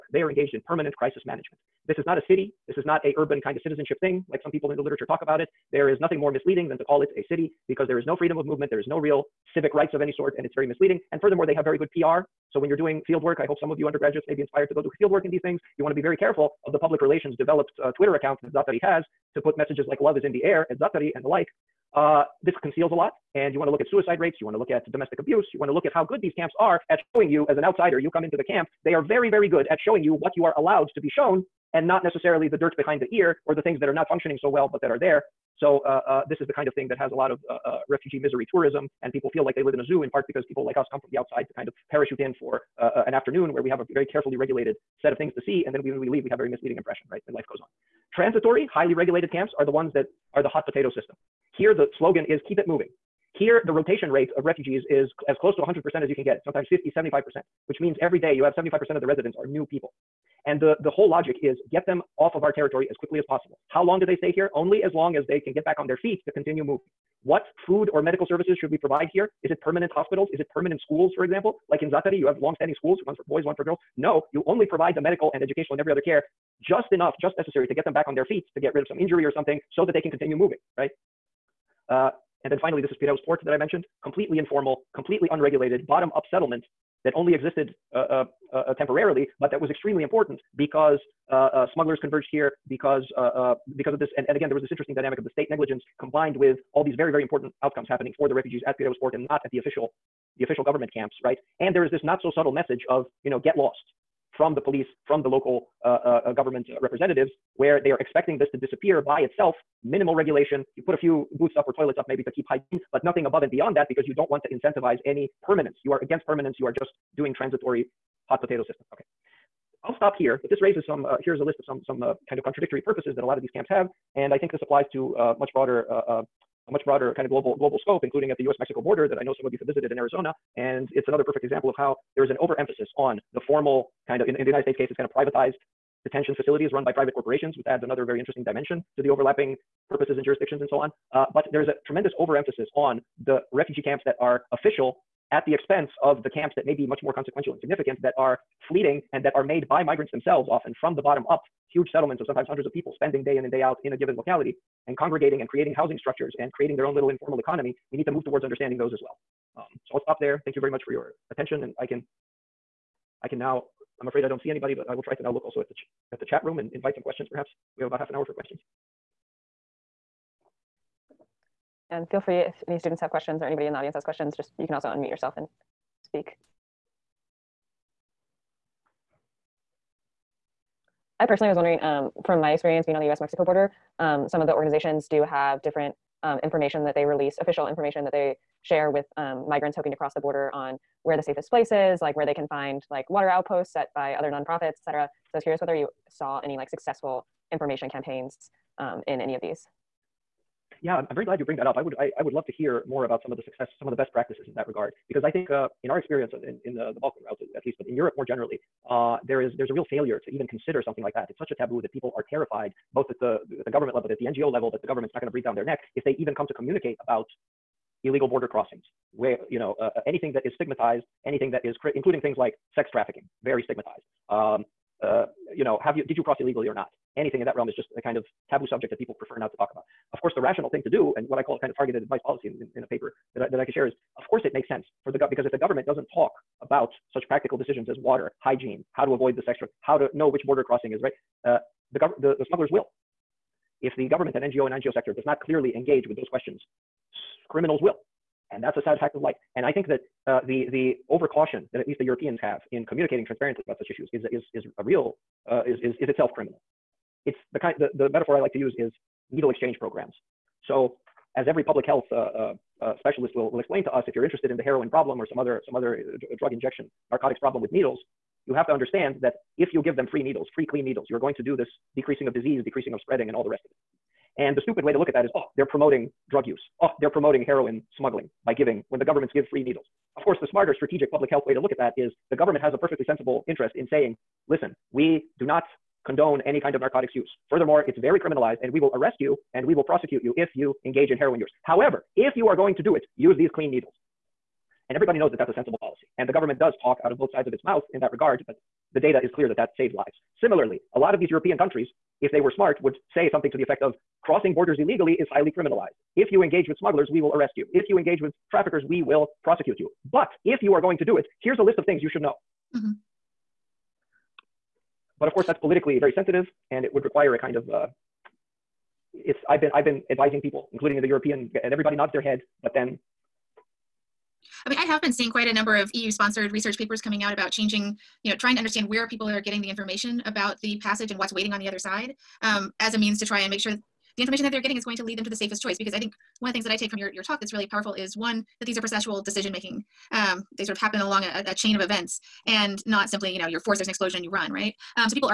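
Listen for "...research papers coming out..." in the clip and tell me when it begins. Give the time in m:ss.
5:26.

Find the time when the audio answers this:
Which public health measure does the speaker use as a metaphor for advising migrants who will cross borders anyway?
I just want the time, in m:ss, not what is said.
4:19.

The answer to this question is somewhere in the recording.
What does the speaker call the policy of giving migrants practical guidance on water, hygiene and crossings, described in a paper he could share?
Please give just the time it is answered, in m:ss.
3:51.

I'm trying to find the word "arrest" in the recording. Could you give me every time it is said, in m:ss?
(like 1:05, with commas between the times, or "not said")
4:48, 5:07.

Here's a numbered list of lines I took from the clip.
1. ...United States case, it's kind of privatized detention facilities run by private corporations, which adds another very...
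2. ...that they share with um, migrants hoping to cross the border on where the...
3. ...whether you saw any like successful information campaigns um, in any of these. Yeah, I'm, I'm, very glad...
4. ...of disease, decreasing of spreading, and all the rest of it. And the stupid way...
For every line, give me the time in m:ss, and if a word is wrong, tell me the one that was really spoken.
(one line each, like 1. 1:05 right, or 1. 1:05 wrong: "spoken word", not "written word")
1. 2:14 right
2. 3:08 right
3. 3:15 right
4. 4:32 right.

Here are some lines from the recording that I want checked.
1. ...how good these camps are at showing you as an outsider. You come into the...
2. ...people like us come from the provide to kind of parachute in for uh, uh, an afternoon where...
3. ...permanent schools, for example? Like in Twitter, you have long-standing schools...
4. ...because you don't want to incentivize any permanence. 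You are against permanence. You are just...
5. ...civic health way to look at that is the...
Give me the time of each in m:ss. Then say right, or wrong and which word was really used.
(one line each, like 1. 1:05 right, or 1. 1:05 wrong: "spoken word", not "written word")
1. 0:25 right
2. 0:40 wrong: "outside", not "provide"
3. 1:10 wrong: "Zaatari", not "Twitter"
4. 1:53 right
5. 4:41 wrong: "public", not "civic".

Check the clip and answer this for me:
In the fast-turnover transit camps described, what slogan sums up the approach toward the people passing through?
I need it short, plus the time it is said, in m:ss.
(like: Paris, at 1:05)
keep it moving, at 0:52.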